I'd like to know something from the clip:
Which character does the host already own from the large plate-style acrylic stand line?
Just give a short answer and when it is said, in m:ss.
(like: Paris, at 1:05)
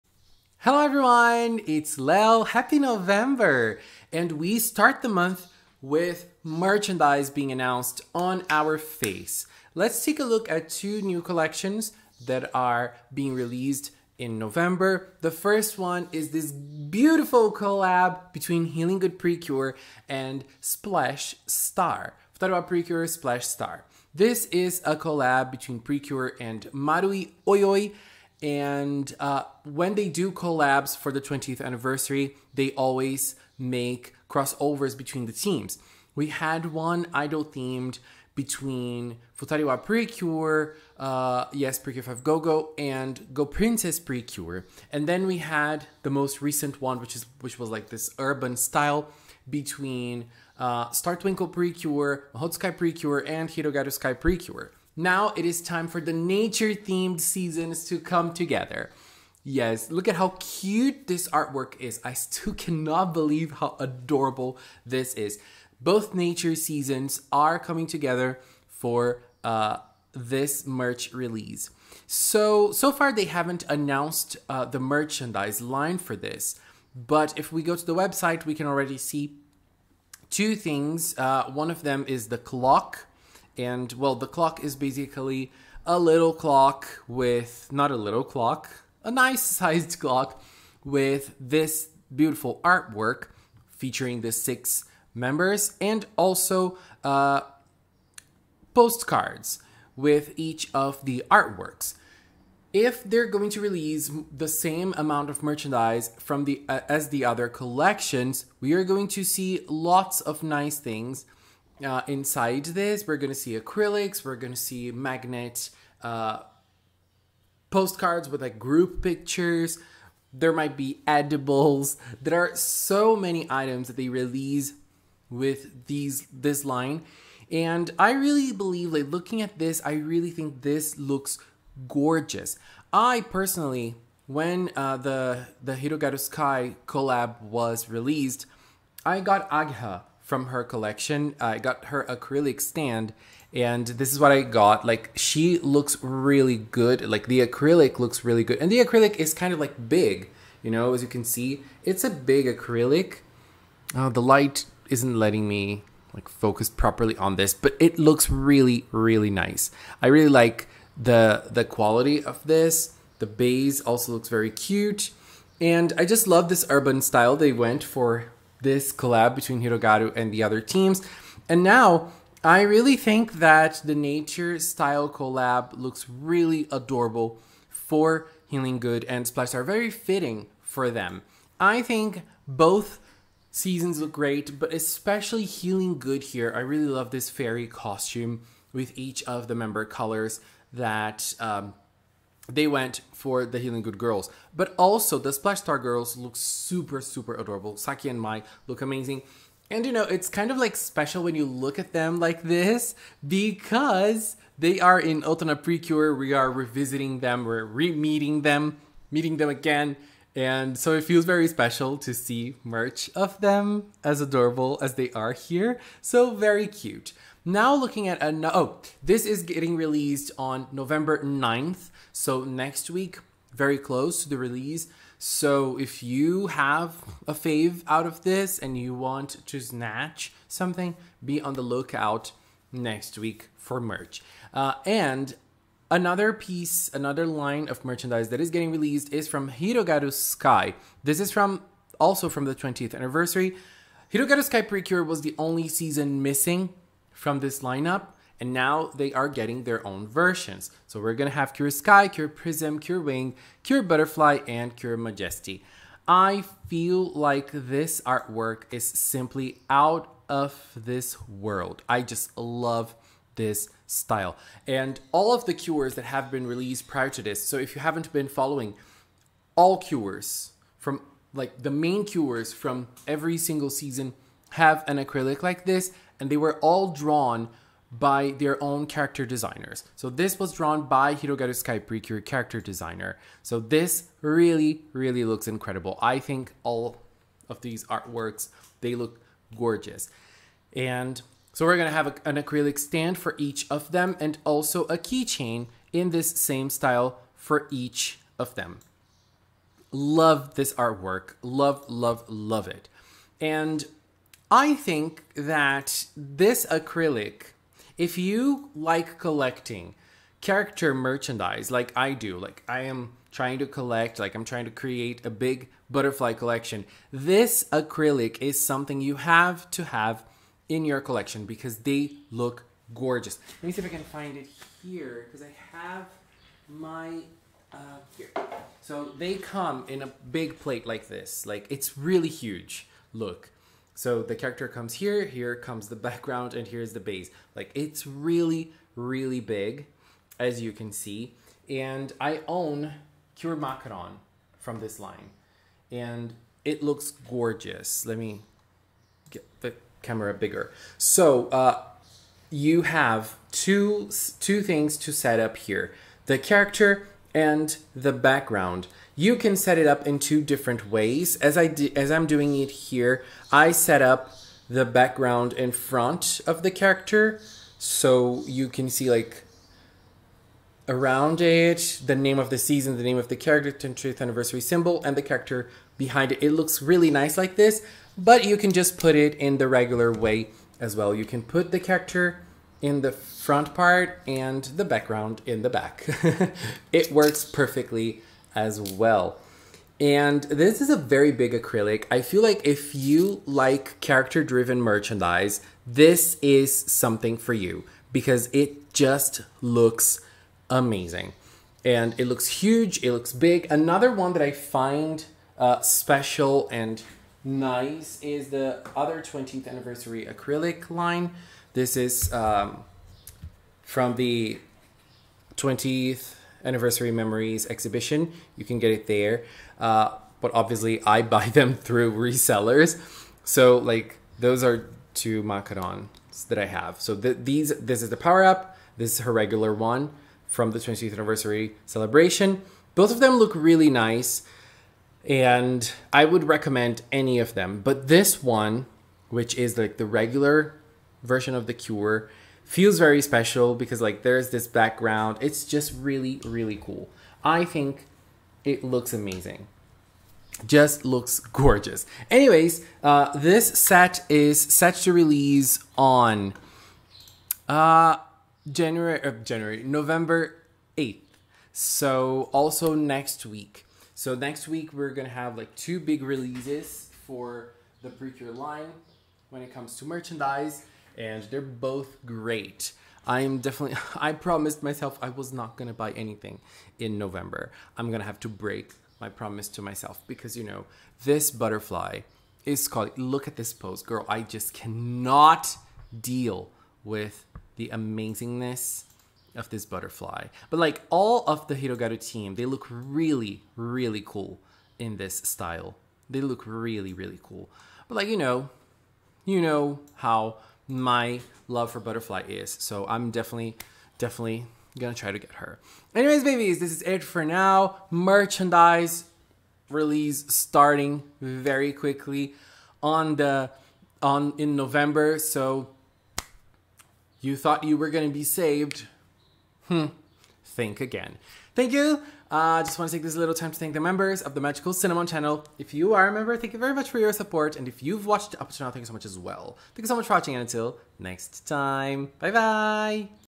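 Cure Macaron, at 5:43.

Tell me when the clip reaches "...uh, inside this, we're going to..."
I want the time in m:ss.
1:51.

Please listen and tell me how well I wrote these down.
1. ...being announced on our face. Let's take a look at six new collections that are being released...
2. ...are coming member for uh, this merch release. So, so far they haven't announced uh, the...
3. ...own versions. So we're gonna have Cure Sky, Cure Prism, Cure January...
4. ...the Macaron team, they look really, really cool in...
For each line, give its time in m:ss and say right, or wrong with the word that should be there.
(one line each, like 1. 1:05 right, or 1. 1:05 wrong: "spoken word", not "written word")
1. 0:07 wrong: "two", not "six"
2. 1:07 wrong: "together", not "member"
3. 4:09 wrong: "Wing", not "January"
4. 8:11 wrong: "Hirogaru", not "Macaron".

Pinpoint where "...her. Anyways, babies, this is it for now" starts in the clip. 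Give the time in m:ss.
8:25.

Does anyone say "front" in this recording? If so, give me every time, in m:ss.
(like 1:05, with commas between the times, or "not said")
6:05, 6:23.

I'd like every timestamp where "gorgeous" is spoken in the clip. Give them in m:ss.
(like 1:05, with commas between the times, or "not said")
2:11, 4:49, 5:22, 5:47, 7:31.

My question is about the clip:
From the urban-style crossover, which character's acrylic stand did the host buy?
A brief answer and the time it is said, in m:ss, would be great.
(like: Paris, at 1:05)
Ageha, at 2:19.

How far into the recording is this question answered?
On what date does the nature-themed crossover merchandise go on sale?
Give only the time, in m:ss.
3:40.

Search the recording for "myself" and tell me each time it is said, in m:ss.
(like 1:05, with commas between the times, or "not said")
7:54, 7:59.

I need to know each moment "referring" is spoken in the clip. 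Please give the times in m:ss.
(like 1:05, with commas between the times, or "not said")
not said.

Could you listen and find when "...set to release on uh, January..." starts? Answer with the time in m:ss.
7:34.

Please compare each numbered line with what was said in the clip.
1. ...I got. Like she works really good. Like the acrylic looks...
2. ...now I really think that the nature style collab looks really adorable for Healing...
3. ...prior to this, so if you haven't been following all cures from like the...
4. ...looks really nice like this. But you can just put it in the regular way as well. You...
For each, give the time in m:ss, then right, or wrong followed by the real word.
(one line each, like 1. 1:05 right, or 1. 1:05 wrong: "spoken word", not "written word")
1. 2:24 wrong: "looks", not "works"
2. 2:51 right
3. 4:26 right
4. 6:16 right.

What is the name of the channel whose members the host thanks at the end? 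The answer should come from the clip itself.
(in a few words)
Magical Cinnamon.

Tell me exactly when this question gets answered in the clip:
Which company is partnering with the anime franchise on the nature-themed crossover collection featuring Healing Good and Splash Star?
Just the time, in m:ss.
0:26.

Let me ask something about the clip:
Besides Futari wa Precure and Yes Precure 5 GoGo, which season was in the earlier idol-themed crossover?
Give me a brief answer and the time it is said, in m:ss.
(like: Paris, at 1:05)
Go Princess Precure, at 0:43.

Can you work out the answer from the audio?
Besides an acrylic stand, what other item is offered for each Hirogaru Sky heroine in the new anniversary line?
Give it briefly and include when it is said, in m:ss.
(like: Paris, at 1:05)
keychain, at 4:54.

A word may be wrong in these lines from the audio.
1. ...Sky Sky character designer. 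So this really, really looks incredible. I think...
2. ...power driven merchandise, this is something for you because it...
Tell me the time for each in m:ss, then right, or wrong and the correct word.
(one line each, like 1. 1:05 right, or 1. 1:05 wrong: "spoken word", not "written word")
1. 4:41 wrong: "Precure", not "Sky"
2. 6:34 wrong: "character", not "power".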